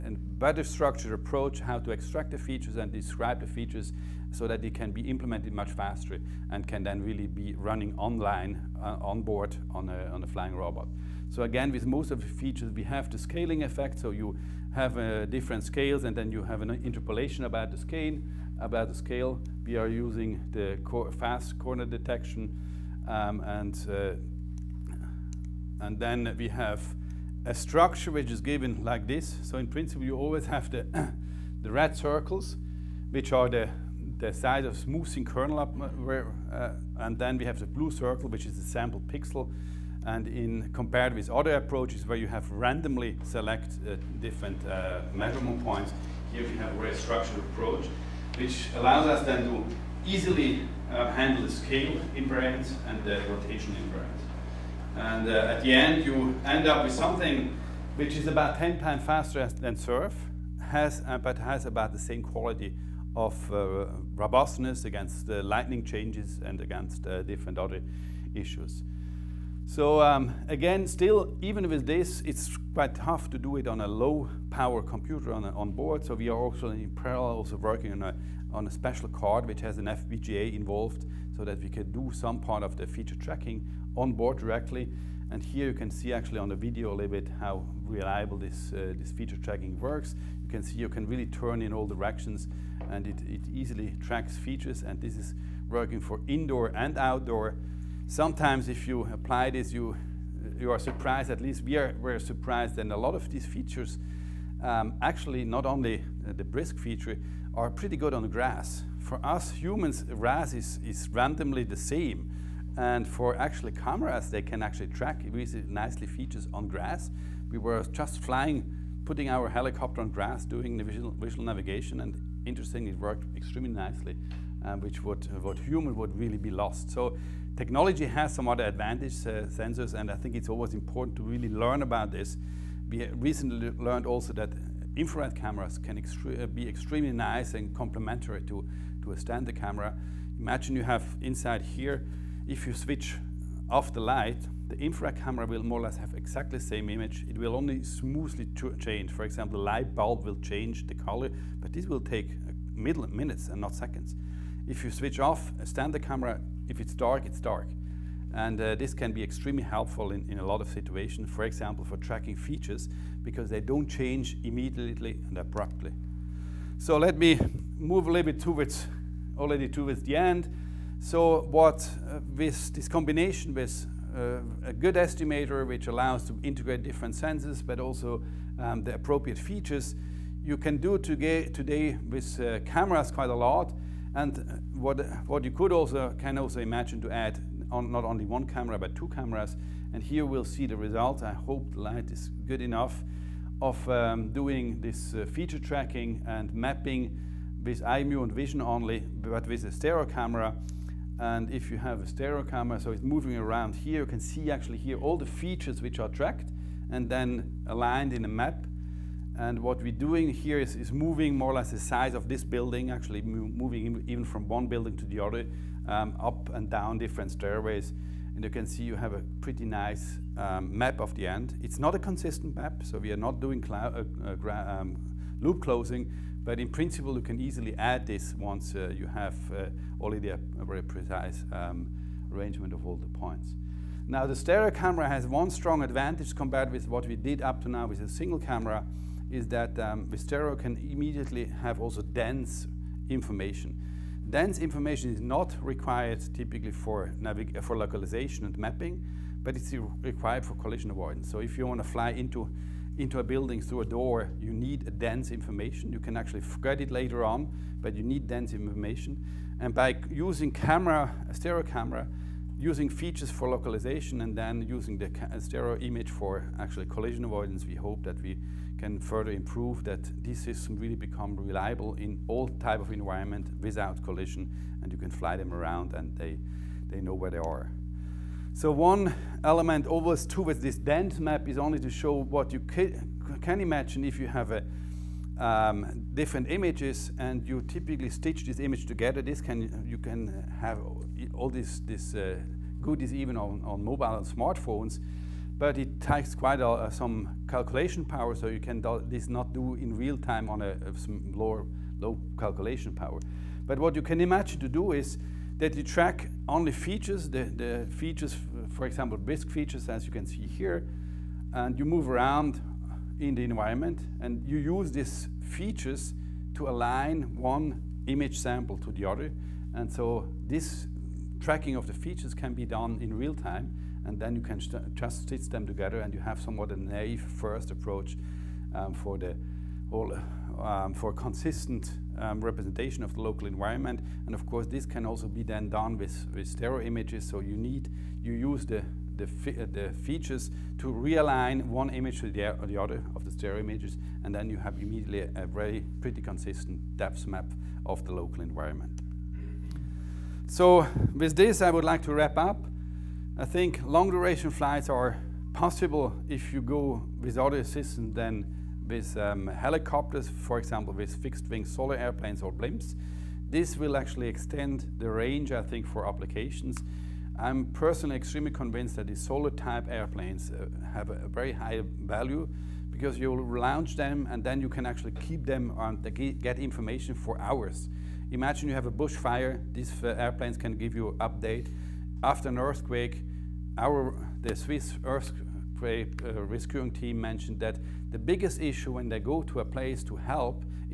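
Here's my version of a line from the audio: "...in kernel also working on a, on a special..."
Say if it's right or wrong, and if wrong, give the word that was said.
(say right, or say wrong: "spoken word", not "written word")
wrong: "parallel", not "kernel".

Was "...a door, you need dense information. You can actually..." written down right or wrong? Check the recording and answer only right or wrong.
right.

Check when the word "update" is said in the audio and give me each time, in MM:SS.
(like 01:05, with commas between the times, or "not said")
06:21.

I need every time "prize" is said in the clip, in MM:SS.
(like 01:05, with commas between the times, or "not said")
not said.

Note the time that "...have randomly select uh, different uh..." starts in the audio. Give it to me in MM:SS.
00:42.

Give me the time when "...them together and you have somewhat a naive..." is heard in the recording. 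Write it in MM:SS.
05:25.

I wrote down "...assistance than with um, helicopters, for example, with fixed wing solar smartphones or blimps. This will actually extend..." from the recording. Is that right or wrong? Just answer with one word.
wrong.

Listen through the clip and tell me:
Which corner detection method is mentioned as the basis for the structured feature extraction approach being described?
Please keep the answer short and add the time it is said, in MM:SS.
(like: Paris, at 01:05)
FAST corner detection, at 00:21.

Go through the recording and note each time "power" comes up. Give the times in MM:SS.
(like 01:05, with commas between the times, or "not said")
01:14, 04:58, 05:02.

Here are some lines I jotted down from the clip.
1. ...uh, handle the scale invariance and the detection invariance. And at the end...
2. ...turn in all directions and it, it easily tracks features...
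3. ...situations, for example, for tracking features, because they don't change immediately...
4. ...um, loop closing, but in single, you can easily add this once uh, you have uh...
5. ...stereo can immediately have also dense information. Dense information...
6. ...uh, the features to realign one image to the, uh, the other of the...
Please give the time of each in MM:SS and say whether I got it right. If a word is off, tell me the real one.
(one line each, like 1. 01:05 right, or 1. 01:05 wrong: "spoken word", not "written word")
1. 00:50 wrong: "rotation", not "detection"
2. 01:31 right
3. 02:40 right
4. 03:44 wrong: "principle", not "single"
5. 04:00 right
6. 05:39 right.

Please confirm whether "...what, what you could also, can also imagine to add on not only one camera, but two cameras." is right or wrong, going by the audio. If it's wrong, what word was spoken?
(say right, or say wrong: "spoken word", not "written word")
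right.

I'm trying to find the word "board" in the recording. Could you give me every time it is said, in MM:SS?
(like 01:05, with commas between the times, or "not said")
00:09, 01:15, 01:24.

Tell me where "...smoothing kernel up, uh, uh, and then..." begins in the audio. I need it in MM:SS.
00:34.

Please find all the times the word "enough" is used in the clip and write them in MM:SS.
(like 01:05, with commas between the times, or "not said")
03:12.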